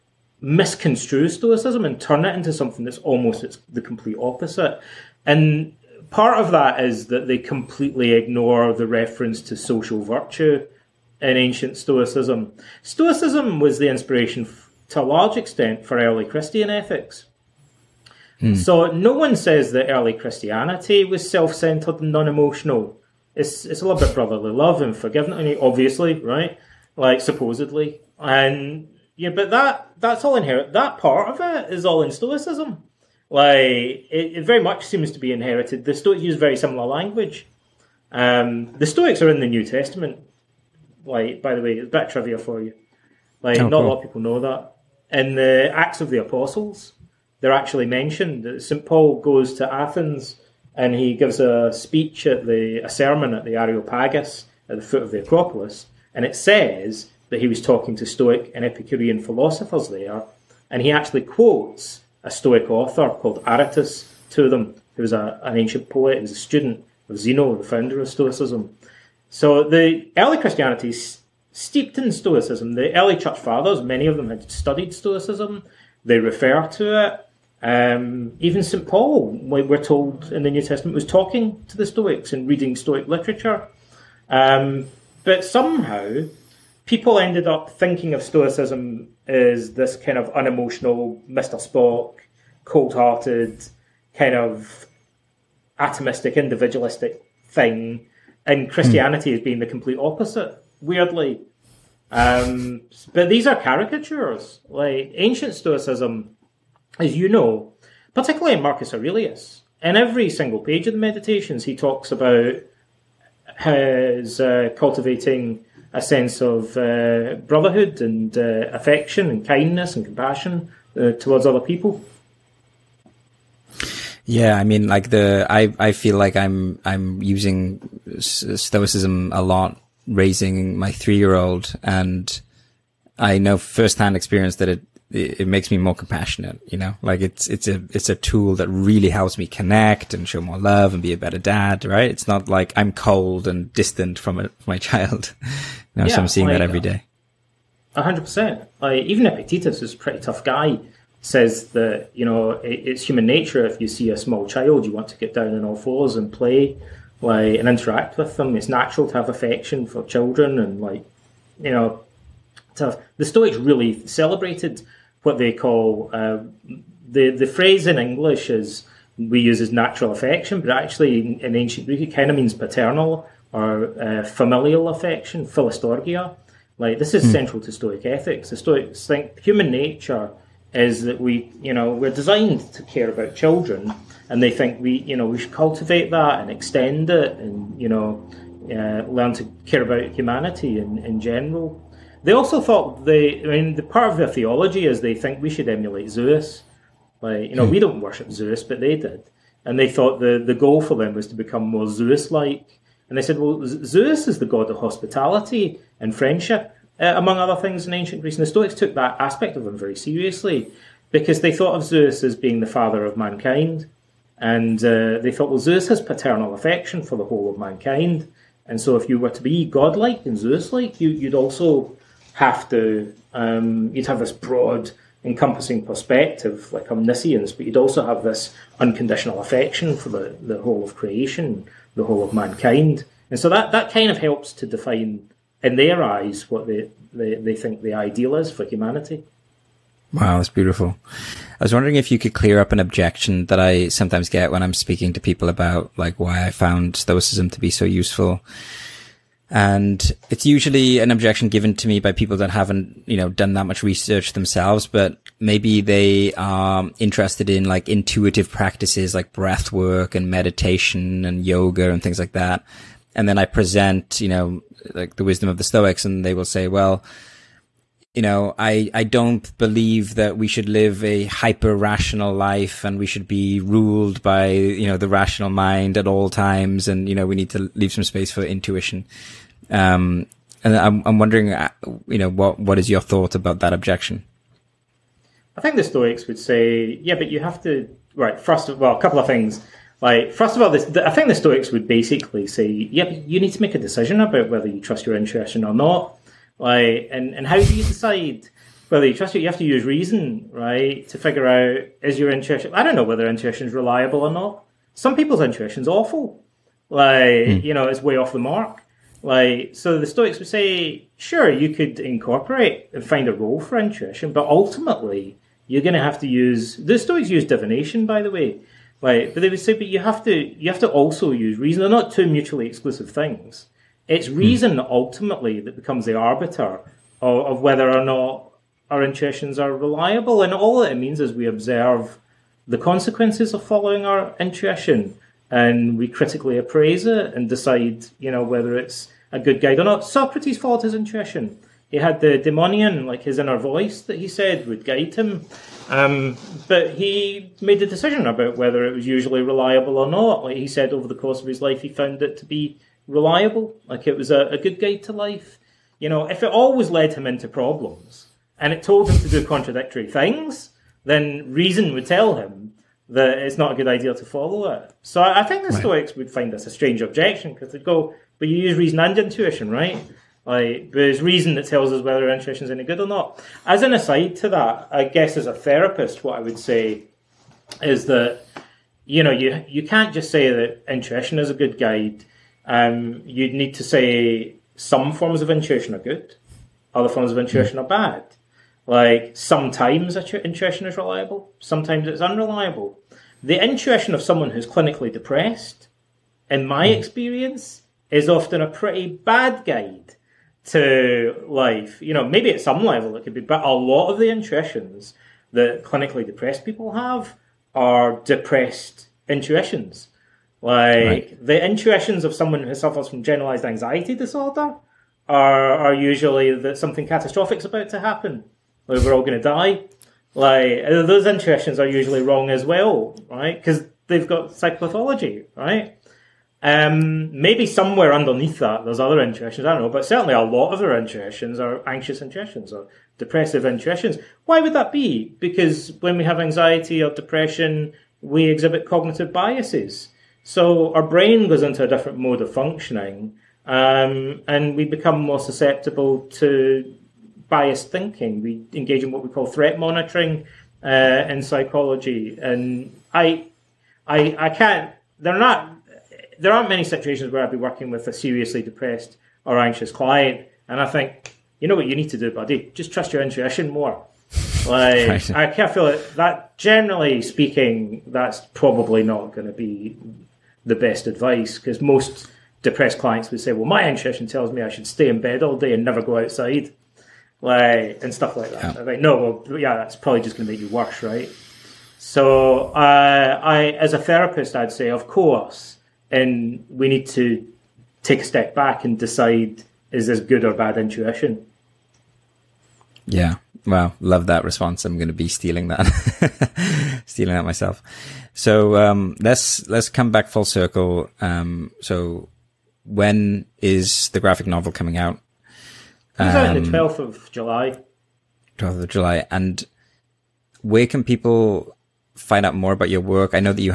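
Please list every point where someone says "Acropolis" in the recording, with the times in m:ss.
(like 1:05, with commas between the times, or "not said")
0:55.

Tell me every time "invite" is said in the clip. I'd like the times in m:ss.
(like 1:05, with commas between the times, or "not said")
not said.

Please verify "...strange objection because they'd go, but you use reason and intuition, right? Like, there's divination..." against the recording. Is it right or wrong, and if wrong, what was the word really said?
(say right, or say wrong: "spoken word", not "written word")
wrong: "reason", not "divination".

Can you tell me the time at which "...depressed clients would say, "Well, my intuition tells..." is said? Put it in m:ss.
7:52.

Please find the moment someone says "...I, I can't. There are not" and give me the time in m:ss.
7:34.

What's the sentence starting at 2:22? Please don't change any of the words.
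It's not like I'm cold and distant from, a, from my child.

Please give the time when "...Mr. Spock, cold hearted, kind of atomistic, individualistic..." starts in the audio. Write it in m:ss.
1:31.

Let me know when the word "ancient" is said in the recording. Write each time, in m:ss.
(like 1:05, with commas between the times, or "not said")
0:11, 1:05, 1:45, 2:51, 3:27.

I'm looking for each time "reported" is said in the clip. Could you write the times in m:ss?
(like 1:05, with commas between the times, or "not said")
not said.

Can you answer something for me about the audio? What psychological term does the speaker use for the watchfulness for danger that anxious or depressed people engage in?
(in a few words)
threat monitoring.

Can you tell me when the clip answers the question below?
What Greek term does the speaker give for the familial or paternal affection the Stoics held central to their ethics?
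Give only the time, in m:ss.
2:55.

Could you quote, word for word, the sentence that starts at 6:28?
Like sometimes intuition is reliable, sometimes it's unreliable.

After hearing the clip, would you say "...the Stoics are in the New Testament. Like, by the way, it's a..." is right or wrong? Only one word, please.
right.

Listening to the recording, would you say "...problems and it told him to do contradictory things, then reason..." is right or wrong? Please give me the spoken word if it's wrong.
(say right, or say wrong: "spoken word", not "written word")
right.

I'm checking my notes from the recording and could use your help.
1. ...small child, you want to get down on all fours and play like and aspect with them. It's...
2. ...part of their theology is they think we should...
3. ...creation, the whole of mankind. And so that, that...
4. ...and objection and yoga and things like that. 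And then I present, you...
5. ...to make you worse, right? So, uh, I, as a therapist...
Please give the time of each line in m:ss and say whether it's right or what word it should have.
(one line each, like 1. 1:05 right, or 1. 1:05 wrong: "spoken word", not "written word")
1. 2:34 wrong: "interact", not "aspect"
2. 3:13 right
3. 3:50 right
4. 4:20 wrong: "meditation", not "objection"
5. 8:00 right.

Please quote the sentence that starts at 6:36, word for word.
experience, is often a pretty bad guide to life.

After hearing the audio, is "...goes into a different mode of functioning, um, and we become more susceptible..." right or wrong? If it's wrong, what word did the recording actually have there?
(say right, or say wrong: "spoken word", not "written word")
right.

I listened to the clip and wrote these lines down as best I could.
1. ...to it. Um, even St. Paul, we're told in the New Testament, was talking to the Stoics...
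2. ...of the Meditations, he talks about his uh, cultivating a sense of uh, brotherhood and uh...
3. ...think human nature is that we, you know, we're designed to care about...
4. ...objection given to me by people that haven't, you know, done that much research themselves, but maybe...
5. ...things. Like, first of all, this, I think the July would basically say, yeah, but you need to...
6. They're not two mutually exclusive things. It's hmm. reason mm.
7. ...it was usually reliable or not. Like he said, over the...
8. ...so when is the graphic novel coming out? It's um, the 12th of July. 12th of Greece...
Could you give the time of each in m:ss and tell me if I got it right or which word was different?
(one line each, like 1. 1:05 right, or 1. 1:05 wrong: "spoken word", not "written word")
1. 1:16 right
2. 1:50 right
3. 2:59 right
4. 4:11 right
5. 4:49 wrong: "Stoics", not "July"
6. 5:21 right
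7. 5:48 right
8. 8:21 wrong: "July", not "Greece".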